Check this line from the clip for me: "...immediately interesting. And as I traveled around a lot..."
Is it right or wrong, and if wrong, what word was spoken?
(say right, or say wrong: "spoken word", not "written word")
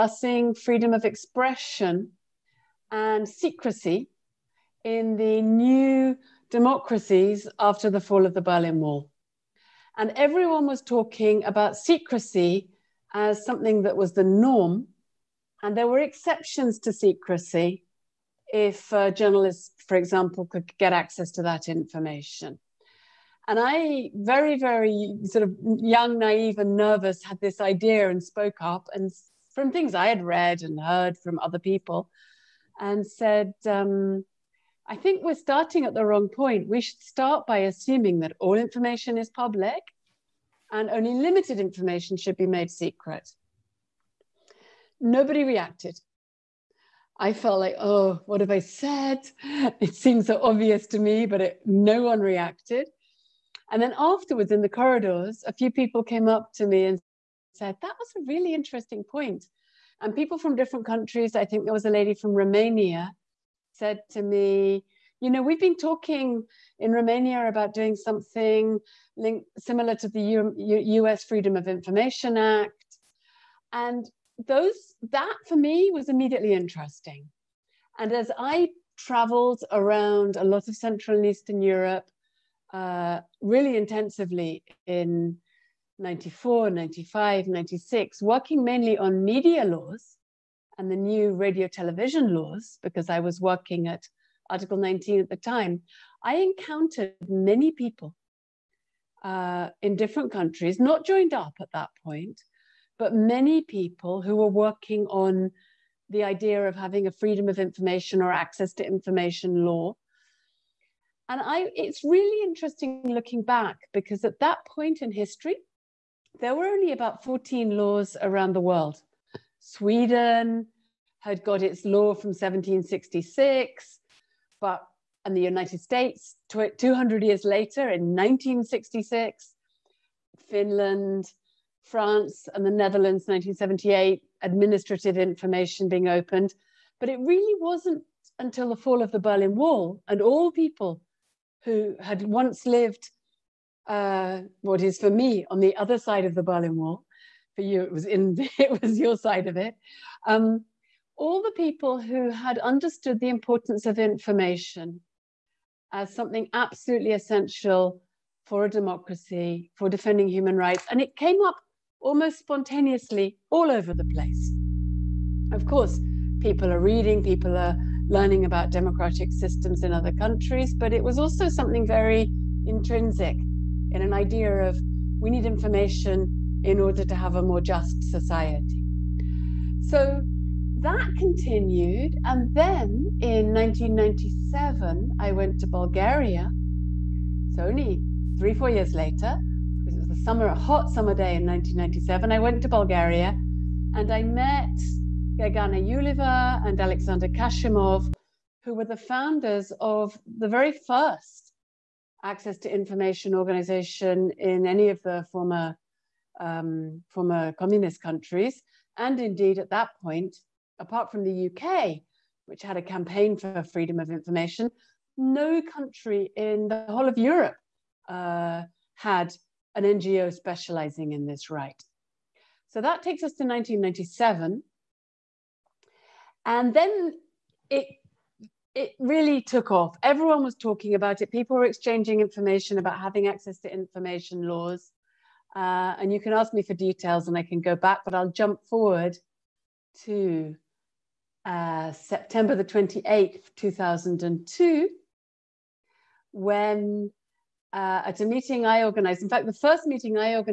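right.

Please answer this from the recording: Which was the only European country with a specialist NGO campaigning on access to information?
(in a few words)
UK.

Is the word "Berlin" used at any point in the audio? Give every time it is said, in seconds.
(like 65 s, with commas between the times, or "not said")
8 s, 139 s, 146 s.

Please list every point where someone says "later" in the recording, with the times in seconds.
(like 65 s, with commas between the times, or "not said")
127 s, 188 s.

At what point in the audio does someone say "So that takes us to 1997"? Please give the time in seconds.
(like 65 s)
222 s.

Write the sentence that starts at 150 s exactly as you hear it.
Um, all the people who had understood the importance of information as something absolutely essential for a democracy, for defending human rights.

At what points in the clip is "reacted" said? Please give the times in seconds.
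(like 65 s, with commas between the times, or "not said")
45 s, 52 s.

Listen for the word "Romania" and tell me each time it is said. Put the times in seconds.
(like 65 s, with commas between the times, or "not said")
62 s, 66 s.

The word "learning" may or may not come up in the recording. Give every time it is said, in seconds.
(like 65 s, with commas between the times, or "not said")
168 s.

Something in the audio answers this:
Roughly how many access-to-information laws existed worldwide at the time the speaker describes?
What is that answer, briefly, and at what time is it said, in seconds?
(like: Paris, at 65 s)
14, at 117 s.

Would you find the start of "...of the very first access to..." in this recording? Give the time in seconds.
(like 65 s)
199 s.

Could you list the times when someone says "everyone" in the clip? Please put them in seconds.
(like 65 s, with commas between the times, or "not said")
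10 s, 230 s.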